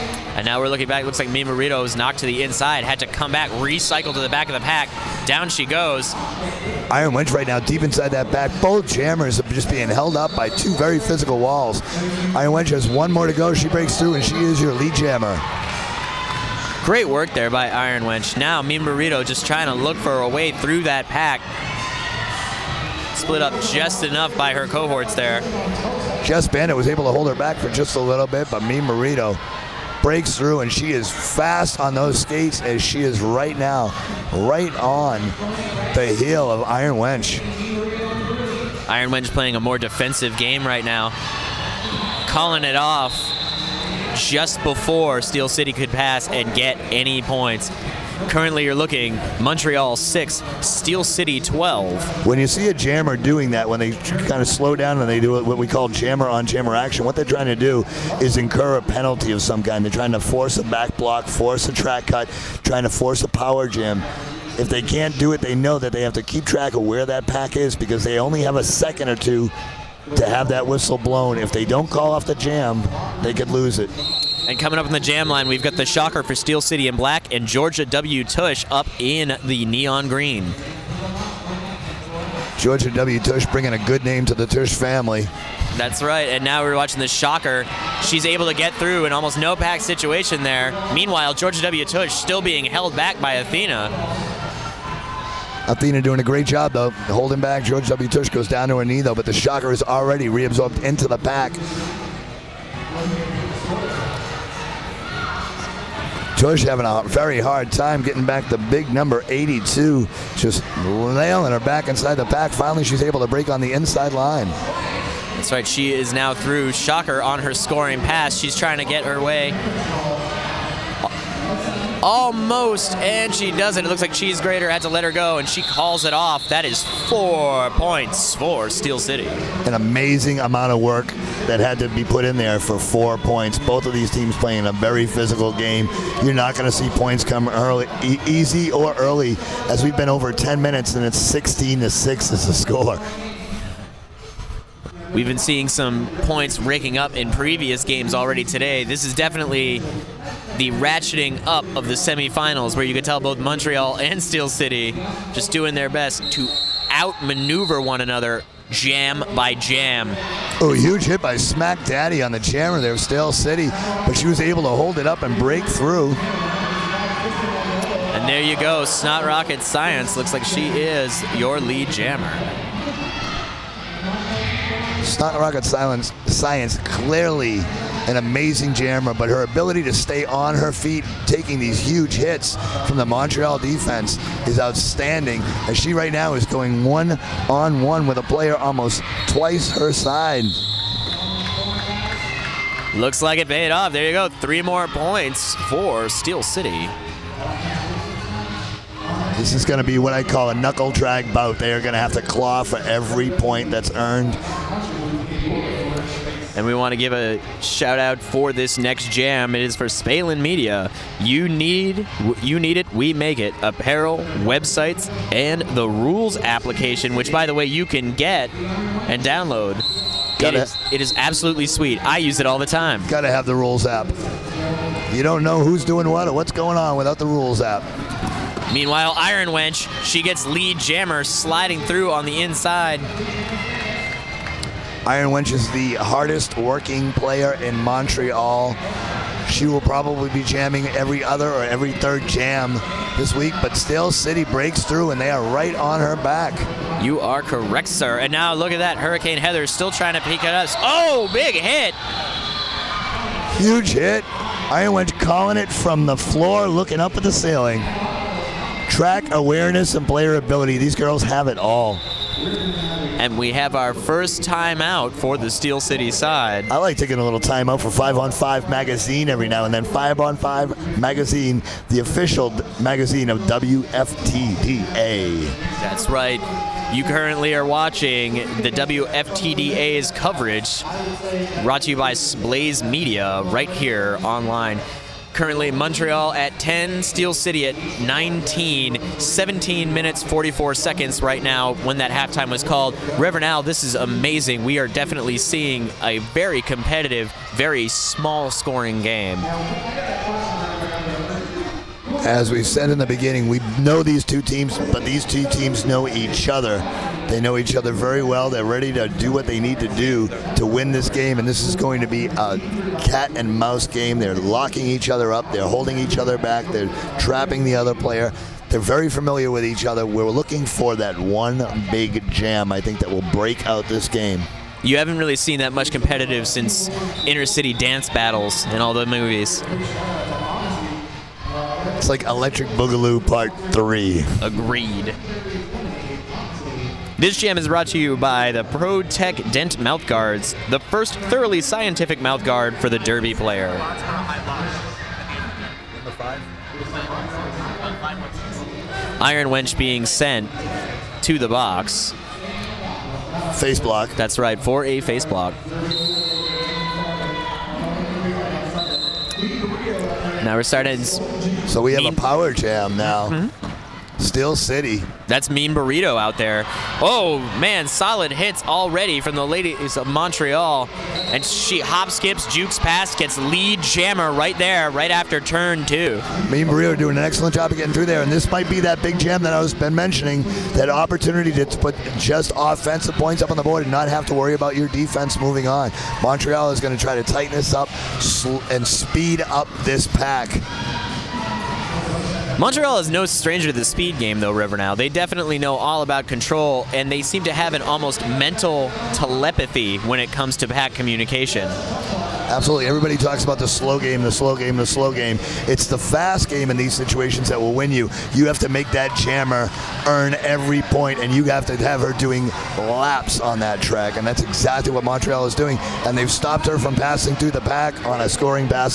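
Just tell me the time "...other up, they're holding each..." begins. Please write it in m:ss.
5:15.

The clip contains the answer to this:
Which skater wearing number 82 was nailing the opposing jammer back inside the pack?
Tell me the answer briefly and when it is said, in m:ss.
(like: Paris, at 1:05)
Joyce, at 1:46.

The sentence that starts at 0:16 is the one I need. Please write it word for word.
Great work there by Iron Wench.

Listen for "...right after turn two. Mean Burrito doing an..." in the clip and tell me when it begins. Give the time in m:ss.
6:14.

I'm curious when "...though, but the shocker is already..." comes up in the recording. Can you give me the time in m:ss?
1:39.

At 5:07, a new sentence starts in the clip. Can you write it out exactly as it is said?
They know each other very well.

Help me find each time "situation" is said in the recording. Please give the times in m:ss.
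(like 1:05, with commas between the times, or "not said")
1:29, 6:46.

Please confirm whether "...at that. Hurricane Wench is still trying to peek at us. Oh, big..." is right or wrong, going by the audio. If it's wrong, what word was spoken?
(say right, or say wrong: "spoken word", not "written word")
wrong: "Heather", not "Wench".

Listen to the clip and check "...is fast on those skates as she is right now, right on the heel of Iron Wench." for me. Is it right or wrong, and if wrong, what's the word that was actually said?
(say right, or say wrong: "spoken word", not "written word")
right.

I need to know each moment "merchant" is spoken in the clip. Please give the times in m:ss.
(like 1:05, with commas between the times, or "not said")
not said.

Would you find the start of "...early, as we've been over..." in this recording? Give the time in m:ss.
2:18.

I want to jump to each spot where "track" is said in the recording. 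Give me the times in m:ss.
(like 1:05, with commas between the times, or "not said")
1:01, 1:06, 4:18, 6:53.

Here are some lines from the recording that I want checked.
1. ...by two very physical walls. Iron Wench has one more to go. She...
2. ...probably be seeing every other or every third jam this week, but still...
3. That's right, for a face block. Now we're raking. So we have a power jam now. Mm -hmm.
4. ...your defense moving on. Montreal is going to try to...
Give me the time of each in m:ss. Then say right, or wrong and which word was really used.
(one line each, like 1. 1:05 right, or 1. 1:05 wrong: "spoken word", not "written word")
1. 0:10 right
2. 3:59 wrong: "jamming", not "seeing"
3. 5:54 wrong: "starting", not "raking"
4. 6:24 right.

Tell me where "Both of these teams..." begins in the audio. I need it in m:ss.
2:13.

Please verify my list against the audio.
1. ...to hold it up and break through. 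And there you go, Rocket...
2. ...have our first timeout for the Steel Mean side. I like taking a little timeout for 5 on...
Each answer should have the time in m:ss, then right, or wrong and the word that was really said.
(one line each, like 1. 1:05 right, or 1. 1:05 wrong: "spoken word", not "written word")
1. 2:44 wrong: "Snot", not "Rocket"
2. 4:23 wrong: "City", not "Mean".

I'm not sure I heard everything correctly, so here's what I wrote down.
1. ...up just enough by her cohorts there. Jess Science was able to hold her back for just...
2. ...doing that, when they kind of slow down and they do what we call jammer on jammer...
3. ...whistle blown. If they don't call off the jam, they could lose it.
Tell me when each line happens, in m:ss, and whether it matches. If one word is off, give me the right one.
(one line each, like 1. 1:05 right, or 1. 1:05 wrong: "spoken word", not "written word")
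1. 0:23 wrong: "Bennett", not "Science"
2. 0:53 right
3. 1:10 right.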